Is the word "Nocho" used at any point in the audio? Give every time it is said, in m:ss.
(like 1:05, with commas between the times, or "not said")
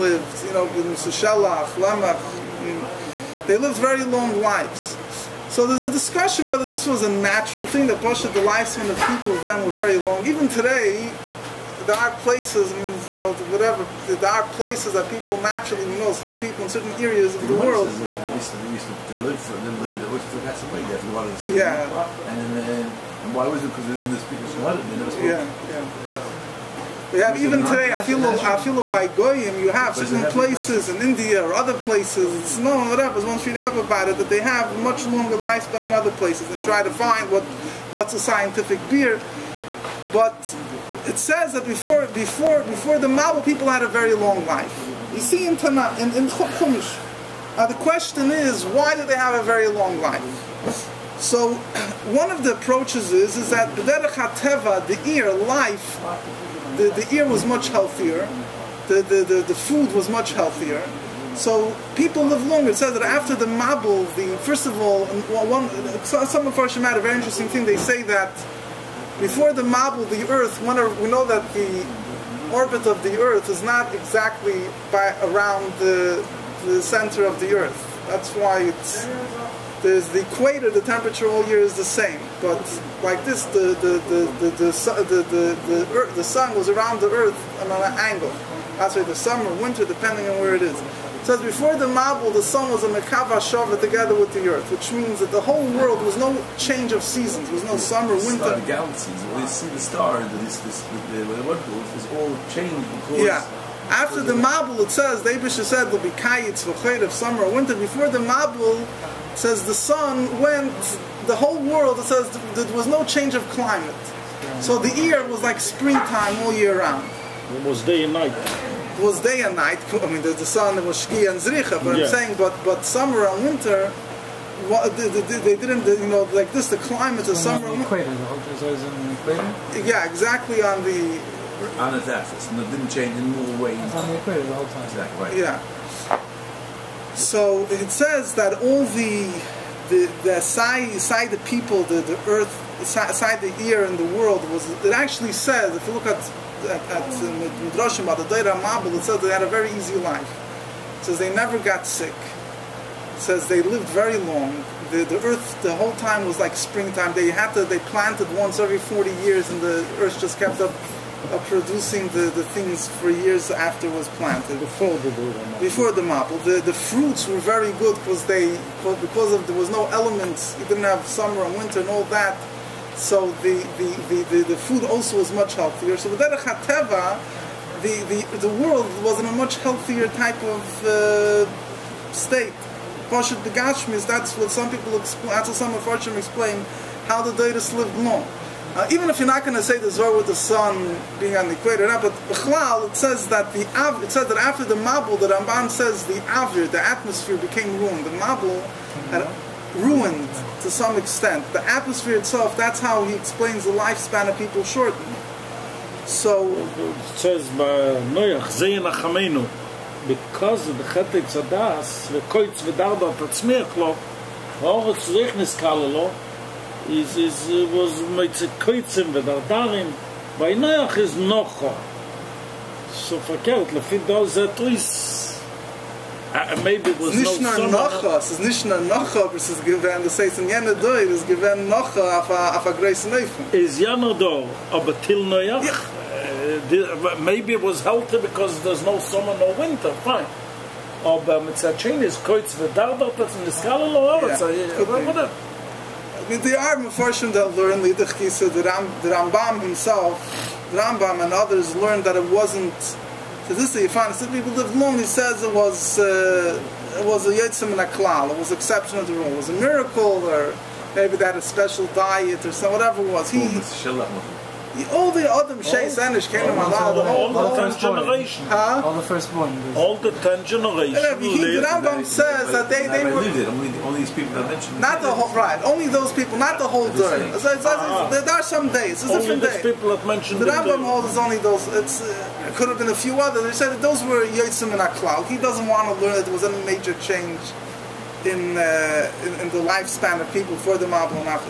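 3:41.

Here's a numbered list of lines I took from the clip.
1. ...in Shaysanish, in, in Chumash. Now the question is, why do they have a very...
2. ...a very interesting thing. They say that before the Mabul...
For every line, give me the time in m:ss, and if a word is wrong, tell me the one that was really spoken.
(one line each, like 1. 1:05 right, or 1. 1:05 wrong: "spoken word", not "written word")
1. 0:45 wrong: "Tanakh", not "Shaysanish"
2. 1:06 right.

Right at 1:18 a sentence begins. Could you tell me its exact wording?
That's why it's there's the equator, the temperature all year is the same.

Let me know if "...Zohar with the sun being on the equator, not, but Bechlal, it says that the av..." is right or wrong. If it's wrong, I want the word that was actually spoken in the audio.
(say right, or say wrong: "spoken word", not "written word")
right.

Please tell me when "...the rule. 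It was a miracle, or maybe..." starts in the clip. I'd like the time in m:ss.
4:19.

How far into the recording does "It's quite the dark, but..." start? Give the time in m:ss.
4:02.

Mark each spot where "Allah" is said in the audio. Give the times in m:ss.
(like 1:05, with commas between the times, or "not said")
4:26.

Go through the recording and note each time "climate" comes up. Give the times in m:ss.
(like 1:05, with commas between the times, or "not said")
1:53, 2:06.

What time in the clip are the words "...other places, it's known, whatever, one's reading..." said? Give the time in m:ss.
0:31.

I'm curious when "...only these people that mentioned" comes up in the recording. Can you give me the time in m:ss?
4:33.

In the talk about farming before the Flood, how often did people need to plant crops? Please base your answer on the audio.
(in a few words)
Once every 40 years.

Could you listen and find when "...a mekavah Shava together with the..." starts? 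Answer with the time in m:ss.
1:32.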